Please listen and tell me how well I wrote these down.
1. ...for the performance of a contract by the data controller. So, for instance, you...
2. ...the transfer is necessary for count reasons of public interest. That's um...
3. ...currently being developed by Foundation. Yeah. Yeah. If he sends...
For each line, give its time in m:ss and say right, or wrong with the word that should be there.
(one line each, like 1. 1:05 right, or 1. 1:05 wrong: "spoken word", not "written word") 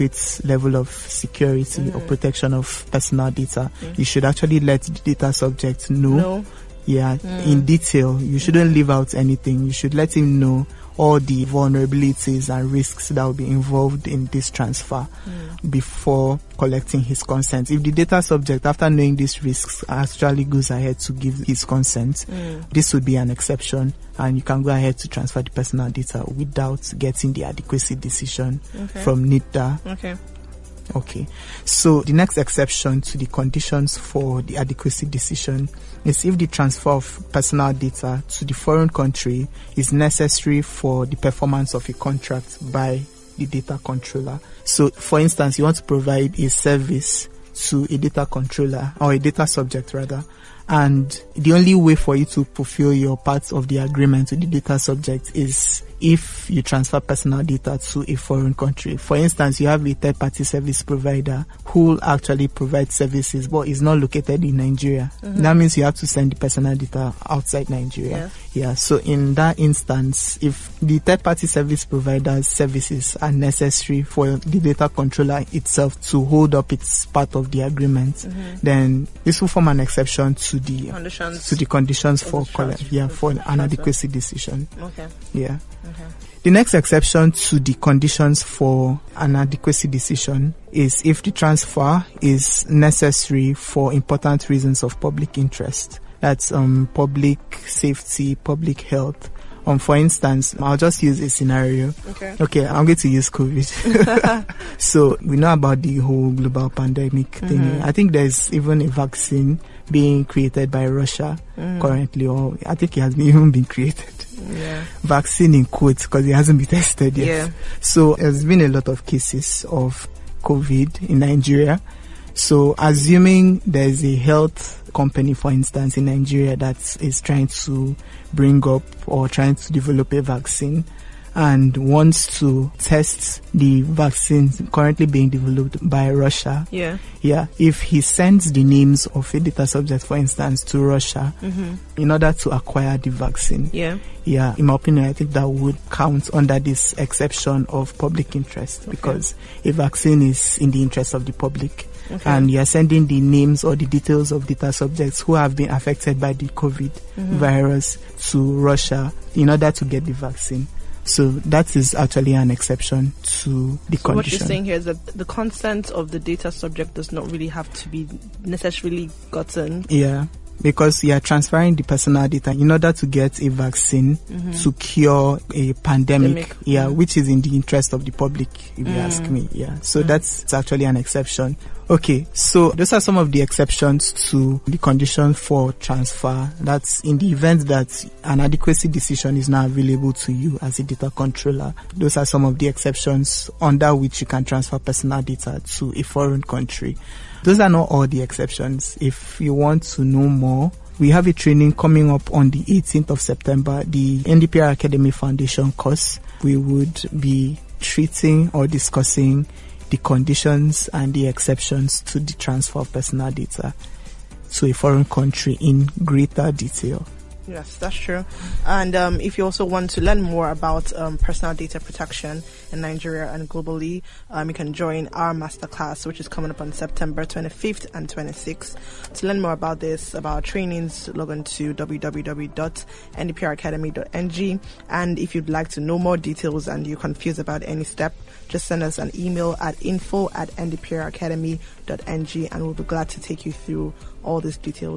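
1. 0:40 right
2. 1:31 wrong: "important", not "count"
3. 2:14 wrong: "Russia", not "Foundation".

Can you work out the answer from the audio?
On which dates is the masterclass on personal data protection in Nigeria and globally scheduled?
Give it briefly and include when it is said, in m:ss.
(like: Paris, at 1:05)
September 25 and 26, at 3:46.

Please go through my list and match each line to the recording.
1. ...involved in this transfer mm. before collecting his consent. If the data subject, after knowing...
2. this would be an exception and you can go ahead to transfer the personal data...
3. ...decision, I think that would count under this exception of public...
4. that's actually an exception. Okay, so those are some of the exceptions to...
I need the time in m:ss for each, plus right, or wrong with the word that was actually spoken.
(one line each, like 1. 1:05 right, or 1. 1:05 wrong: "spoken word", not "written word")
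1. 0:13 right
2. 0:22 right
3. 2:24 wrong: "opinion", not "decision"
4. 3:00 right.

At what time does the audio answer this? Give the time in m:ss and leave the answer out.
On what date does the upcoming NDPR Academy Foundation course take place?
3:22.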